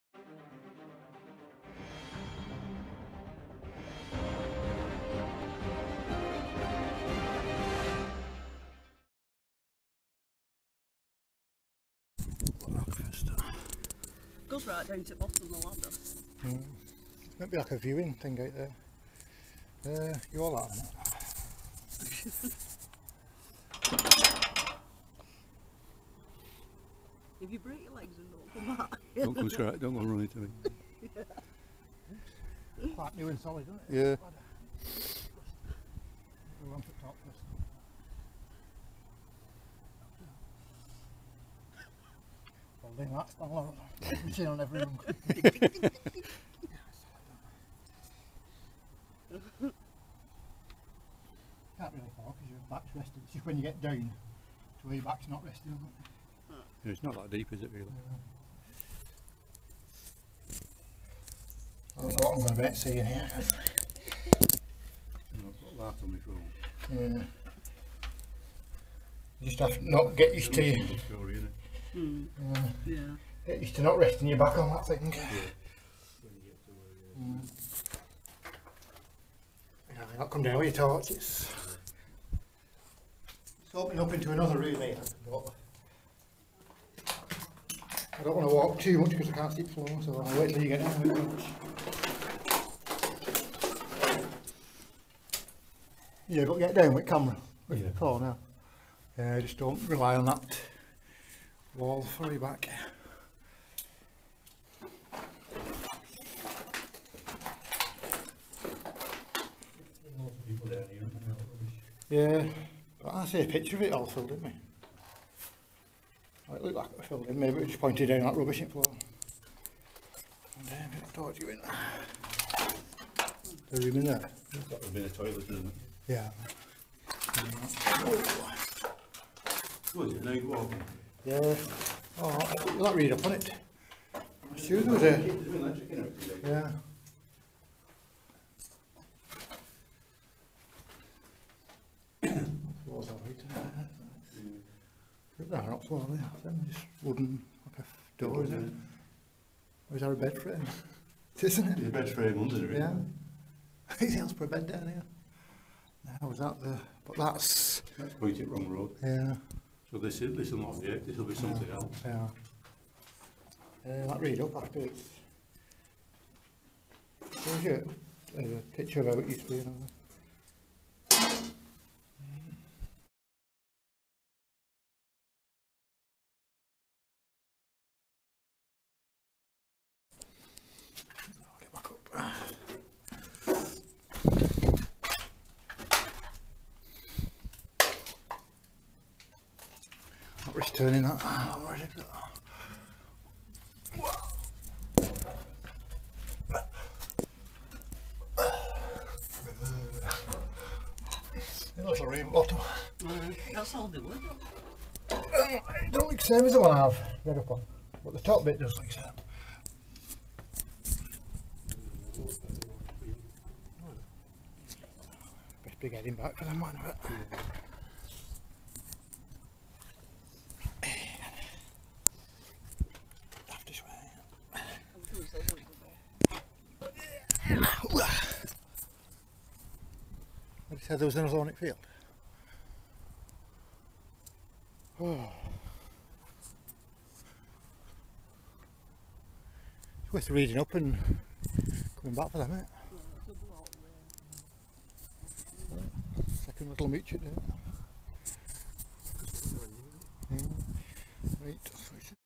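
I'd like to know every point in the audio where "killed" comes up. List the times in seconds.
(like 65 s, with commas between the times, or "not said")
not said.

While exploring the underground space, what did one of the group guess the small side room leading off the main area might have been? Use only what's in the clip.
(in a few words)
the toilet.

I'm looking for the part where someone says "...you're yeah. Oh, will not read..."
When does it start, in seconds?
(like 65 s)
130 s.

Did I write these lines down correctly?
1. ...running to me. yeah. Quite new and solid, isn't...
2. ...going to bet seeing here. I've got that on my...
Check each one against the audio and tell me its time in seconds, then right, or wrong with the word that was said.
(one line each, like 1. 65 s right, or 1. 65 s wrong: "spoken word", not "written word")
1. 30 s right
2. 62 s right.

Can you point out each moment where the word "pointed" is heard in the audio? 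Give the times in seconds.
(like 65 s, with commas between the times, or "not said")
117 s, 158 s.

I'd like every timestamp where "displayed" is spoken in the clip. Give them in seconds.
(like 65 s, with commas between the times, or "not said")
not said.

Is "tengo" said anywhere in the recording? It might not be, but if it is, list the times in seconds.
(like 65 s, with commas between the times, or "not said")
not said.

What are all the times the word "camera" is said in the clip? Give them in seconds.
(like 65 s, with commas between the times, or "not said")
97 s.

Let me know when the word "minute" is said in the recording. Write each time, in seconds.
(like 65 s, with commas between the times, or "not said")
242 s.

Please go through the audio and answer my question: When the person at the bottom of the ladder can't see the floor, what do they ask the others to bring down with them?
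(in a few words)
torches.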